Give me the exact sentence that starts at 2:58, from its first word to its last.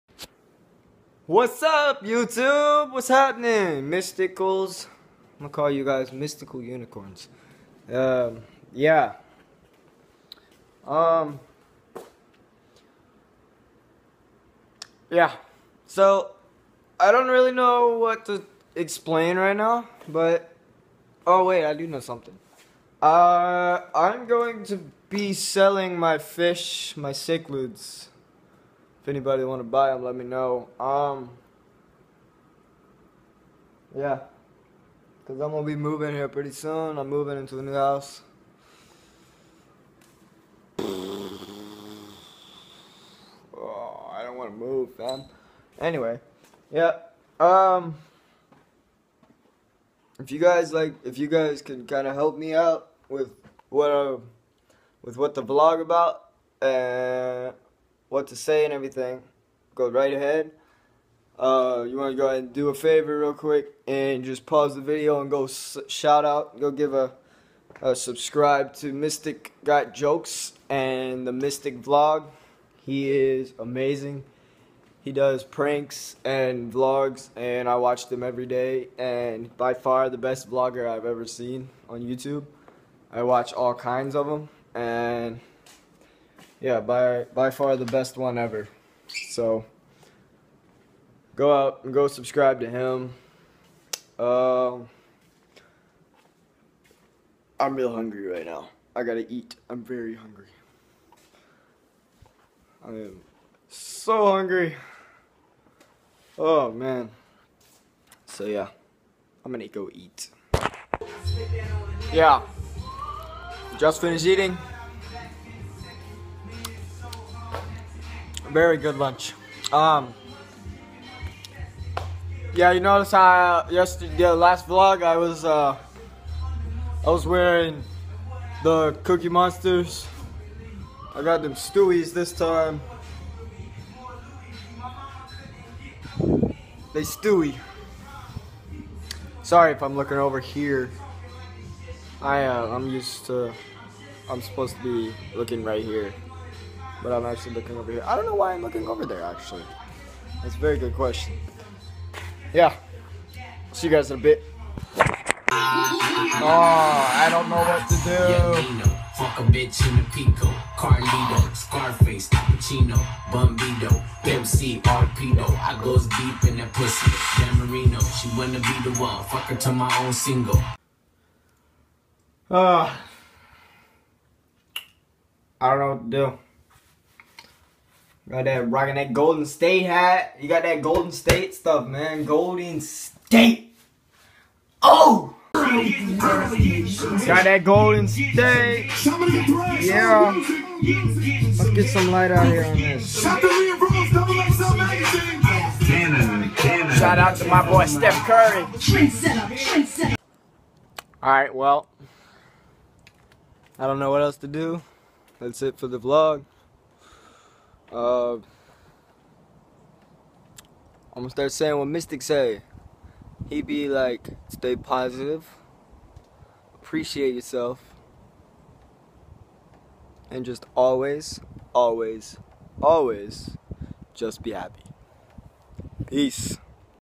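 Got that rocking that Golden State hat.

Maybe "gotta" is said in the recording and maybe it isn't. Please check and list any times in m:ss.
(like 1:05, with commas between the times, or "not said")
1:39.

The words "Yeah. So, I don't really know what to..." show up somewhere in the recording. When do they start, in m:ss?
0:15.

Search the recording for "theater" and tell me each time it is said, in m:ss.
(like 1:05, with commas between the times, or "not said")
not said.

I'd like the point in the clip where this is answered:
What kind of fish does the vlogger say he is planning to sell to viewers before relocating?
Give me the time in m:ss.
0:27.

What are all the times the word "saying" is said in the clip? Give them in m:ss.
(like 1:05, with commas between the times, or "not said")
3:31.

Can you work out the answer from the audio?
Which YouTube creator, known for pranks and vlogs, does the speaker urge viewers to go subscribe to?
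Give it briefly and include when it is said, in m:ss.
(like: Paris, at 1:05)
Mystic Got Jokes, at 1:08.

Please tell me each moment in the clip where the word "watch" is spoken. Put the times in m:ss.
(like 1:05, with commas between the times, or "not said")
1:17, 1:23.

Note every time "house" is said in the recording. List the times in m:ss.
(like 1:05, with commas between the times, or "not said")
0:37.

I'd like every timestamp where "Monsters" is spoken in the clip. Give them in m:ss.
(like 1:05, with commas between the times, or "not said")
2:09.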